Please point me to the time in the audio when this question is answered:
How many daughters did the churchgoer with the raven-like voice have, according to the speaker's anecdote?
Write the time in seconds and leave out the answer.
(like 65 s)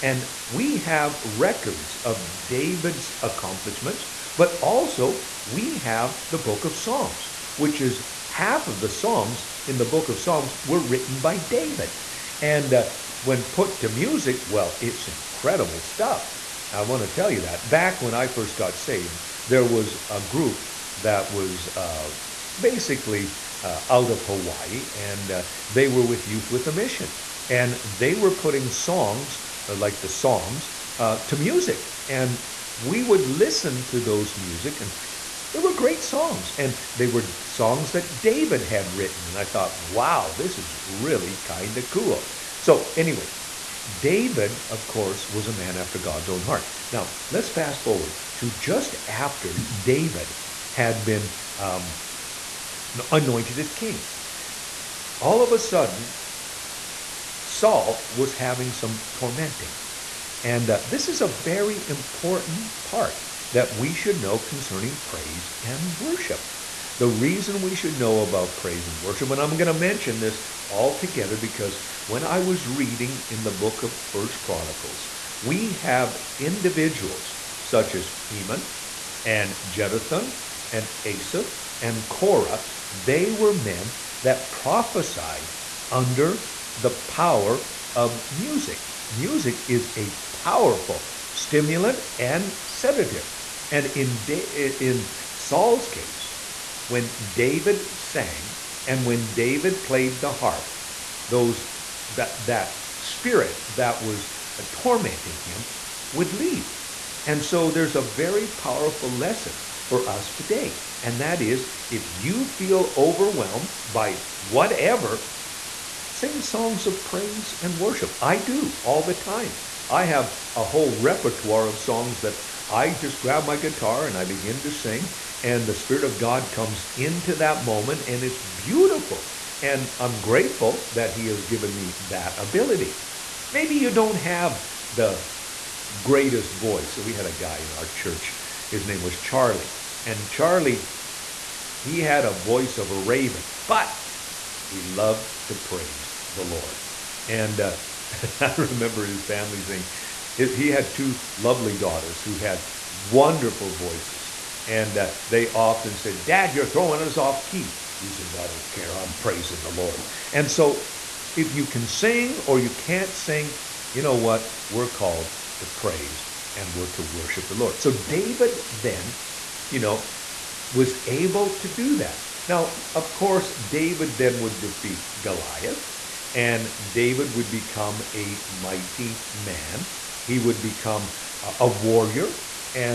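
150 s.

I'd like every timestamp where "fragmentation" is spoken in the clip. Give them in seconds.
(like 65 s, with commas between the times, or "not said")
not said.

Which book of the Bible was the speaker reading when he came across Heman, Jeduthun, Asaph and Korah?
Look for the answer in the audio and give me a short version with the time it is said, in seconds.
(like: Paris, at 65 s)
First Chronicles, at 74 s.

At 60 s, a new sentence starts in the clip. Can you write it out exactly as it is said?
And uh, this is a very important part that we should know concerning praise and worship.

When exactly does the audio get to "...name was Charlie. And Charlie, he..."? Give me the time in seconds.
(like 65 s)
138 s.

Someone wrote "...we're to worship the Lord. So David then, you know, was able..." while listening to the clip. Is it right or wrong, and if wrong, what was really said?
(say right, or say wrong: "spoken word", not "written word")
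right.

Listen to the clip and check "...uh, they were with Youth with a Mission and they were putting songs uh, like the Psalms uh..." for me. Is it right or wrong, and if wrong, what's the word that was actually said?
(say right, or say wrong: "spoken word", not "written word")
right.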